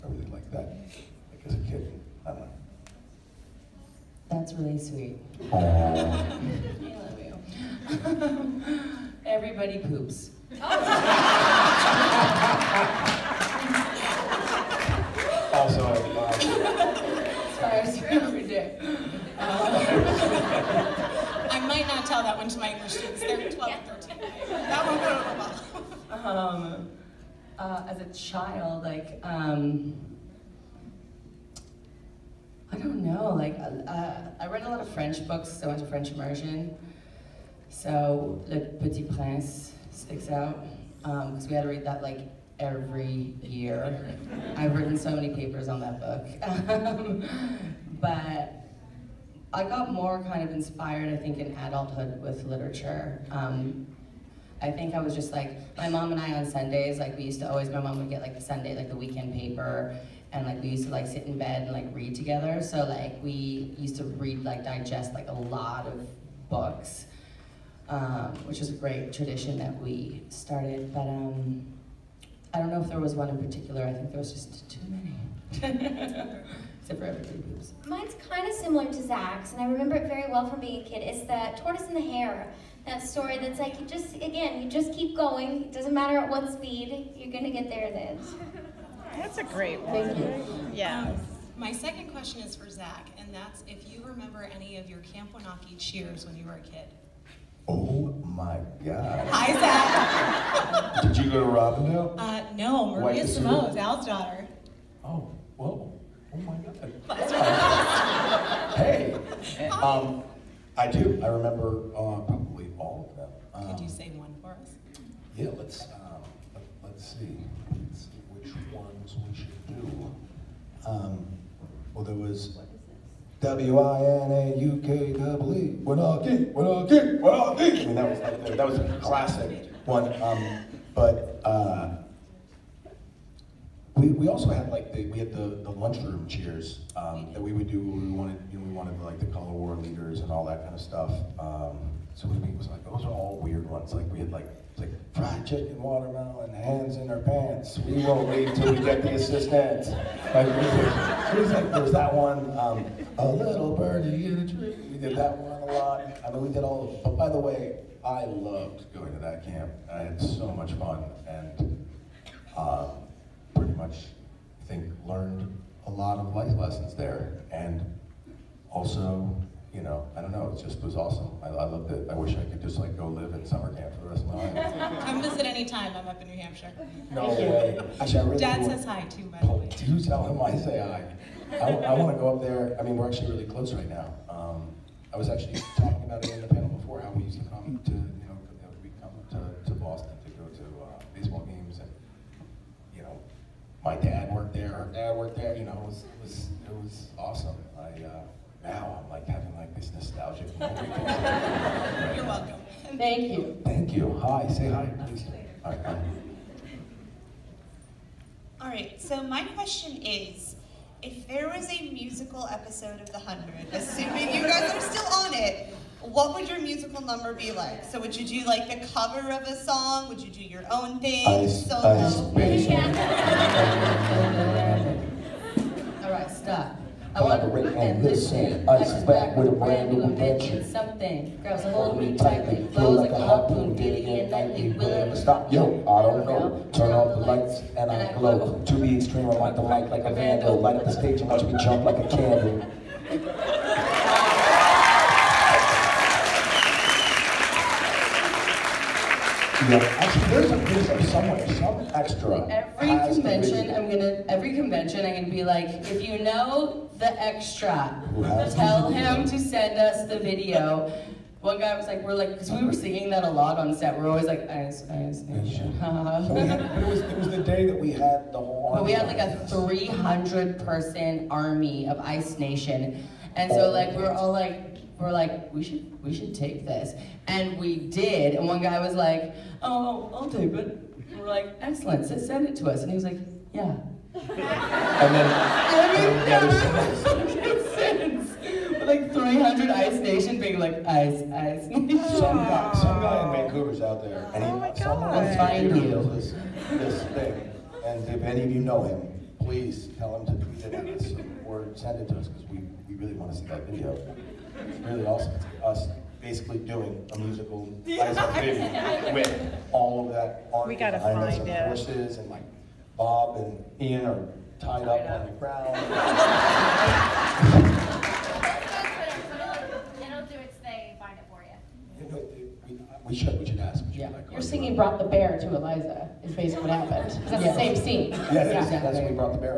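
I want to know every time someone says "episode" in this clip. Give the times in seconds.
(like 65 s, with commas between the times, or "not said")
212 s.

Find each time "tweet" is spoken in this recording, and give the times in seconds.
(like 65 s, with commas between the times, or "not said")
300 s.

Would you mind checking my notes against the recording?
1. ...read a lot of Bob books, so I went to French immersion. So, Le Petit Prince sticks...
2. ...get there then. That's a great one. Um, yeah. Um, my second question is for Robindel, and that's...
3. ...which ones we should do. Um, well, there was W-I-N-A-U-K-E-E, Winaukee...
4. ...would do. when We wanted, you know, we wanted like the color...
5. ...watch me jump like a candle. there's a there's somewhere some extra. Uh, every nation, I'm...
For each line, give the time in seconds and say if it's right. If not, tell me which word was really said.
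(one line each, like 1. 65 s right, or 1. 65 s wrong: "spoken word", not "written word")
1. 34 s wrong: "French", not "Bob"
2. 87 s wrong: "Zach", not "Robindel"
3. 118 s right
4. 137 s right
5. 241 s wrong: "convention", not "nation".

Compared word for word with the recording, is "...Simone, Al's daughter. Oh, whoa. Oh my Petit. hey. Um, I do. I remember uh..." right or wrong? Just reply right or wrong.
wrong.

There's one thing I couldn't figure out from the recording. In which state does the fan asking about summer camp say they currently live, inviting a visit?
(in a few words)
New Hampshire.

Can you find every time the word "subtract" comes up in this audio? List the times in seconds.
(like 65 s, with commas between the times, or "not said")
not said.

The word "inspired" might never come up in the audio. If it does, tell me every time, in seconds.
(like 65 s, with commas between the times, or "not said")
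50 s.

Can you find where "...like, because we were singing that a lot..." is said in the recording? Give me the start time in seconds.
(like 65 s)
262 s.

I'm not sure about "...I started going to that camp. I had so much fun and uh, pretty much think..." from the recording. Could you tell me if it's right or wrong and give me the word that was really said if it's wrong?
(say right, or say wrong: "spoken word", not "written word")
wrong: "loved", not "started".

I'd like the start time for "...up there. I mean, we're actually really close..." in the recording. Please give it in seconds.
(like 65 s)
182 s.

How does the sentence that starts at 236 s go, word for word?
Turn off the lights and I glow.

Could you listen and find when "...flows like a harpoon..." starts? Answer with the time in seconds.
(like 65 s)
232 s.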